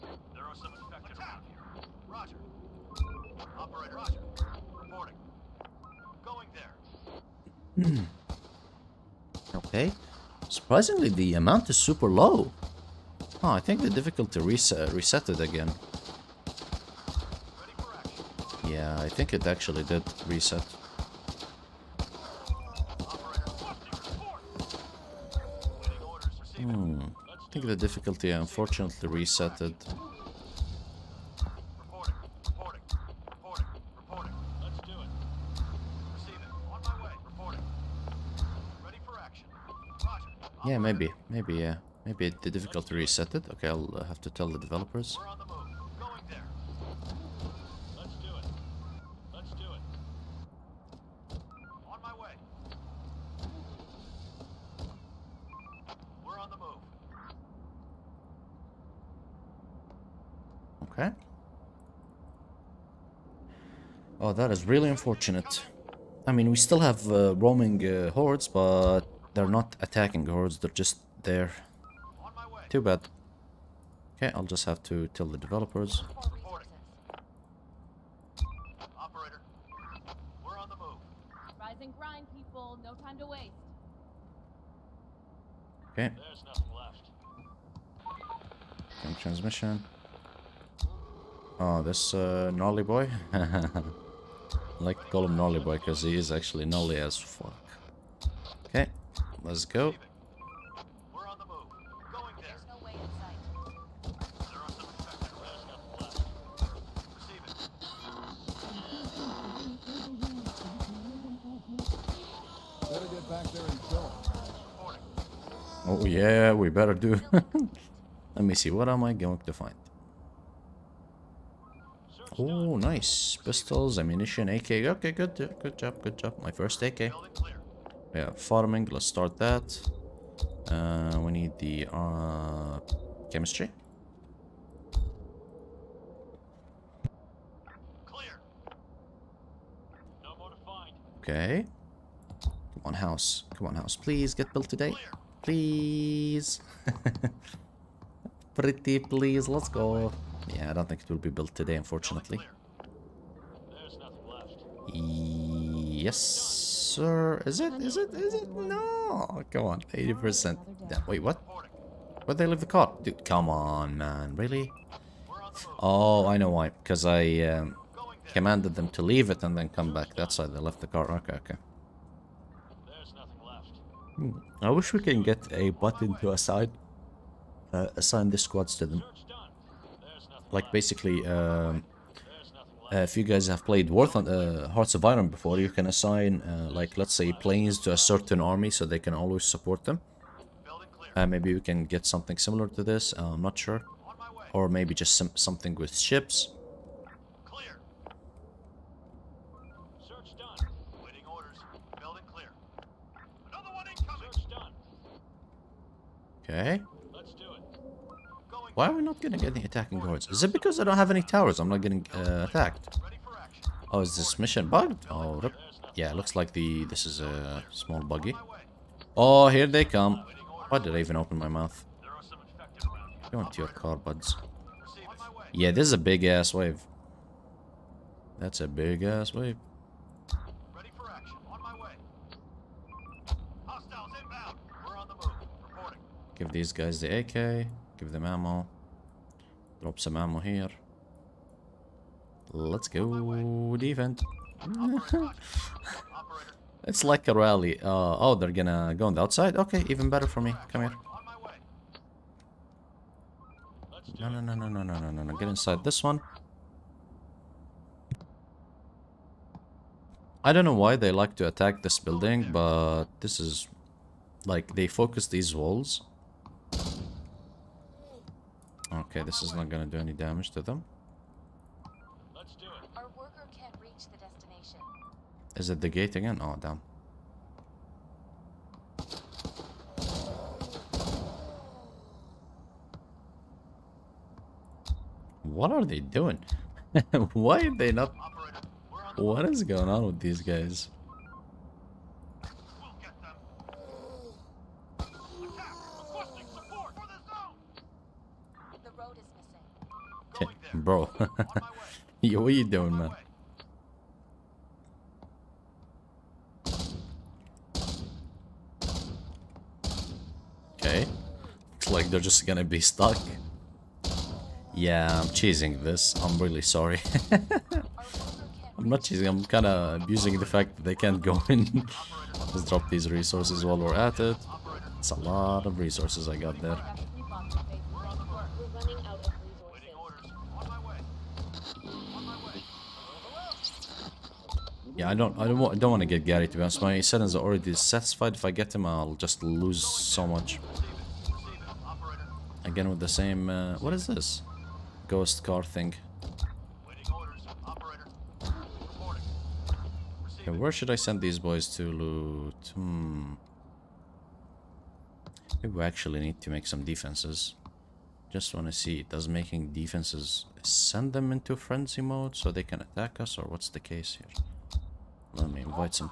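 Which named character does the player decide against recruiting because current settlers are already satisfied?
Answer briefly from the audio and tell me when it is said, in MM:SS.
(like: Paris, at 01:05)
Gary, at 05:36.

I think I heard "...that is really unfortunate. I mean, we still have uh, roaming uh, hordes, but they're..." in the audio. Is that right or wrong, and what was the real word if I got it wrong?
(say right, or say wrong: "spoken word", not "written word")
right.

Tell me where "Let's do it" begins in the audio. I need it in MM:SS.
04:32.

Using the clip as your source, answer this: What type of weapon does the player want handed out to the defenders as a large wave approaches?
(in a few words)
AK.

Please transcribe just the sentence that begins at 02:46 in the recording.
Because I um, commanded them to leave it and then come back.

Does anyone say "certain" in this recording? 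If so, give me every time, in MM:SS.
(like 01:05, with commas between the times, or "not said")
03:07.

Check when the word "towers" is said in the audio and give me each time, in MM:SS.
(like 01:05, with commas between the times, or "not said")
03:31.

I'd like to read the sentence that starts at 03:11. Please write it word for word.
Uh, maybe we can get something similar to this, I'm not sure.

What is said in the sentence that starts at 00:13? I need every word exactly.
Oh, I think the difficulty res uh, reset it again.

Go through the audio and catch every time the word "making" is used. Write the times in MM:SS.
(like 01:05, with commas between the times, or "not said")
05:59.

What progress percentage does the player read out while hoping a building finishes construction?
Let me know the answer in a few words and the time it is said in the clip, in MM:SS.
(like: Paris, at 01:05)
80%, at 02:39.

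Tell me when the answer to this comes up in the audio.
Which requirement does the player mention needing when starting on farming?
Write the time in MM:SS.
02:13.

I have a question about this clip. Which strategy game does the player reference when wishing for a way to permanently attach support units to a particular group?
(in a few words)
Hearts of Iron.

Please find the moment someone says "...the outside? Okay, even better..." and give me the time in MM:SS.
04:09.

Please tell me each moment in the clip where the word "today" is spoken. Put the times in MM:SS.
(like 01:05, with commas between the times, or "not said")
02:24, 02:31.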